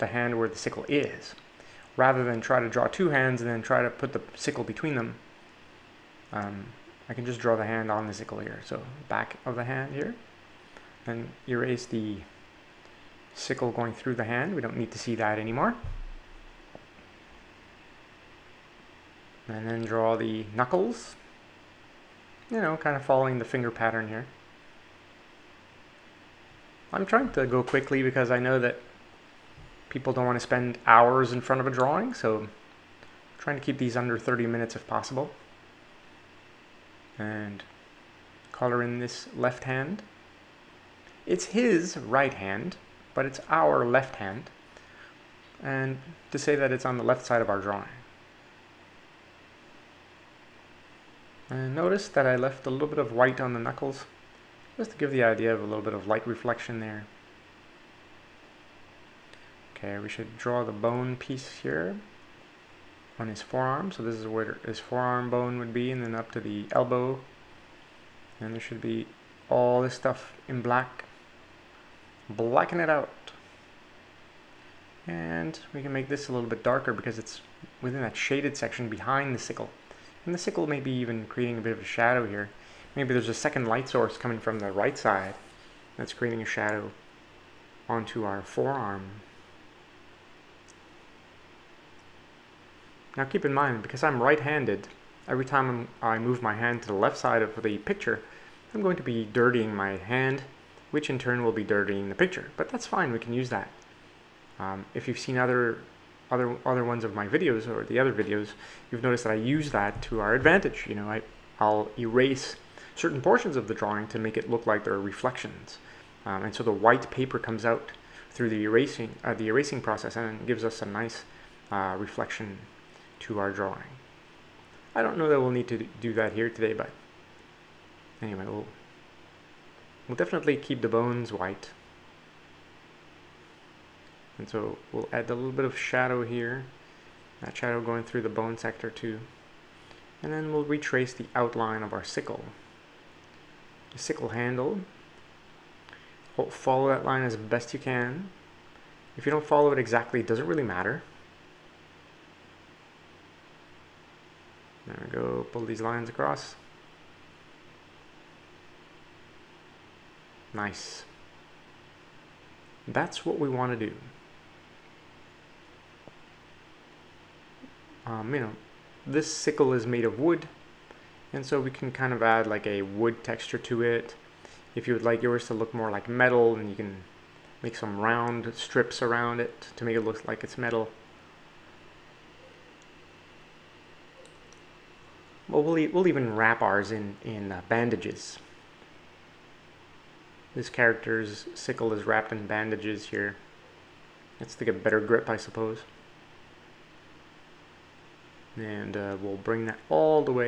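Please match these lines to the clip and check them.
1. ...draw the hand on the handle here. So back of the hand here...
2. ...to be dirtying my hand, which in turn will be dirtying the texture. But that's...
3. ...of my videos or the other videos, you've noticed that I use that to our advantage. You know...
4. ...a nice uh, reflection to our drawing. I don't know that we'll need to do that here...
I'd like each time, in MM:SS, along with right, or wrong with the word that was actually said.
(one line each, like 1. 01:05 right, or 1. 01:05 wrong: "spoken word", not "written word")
1. 00:07 wrong: "sickle", not "handle"
2. 01:38 wrong: "picture", not "texture"
3. 01:47 right
4. 02:00 right.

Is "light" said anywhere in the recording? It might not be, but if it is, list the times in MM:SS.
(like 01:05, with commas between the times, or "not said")
00:56, 01:23.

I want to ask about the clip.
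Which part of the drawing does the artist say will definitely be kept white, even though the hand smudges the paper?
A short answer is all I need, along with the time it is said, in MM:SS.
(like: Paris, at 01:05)
the bones, at 02:10.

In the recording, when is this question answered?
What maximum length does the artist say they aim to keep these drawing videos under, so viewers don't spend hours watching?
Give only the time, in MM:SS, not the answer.
00:34.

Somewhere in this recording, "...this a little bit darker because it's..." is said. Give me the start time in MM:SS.
01:16.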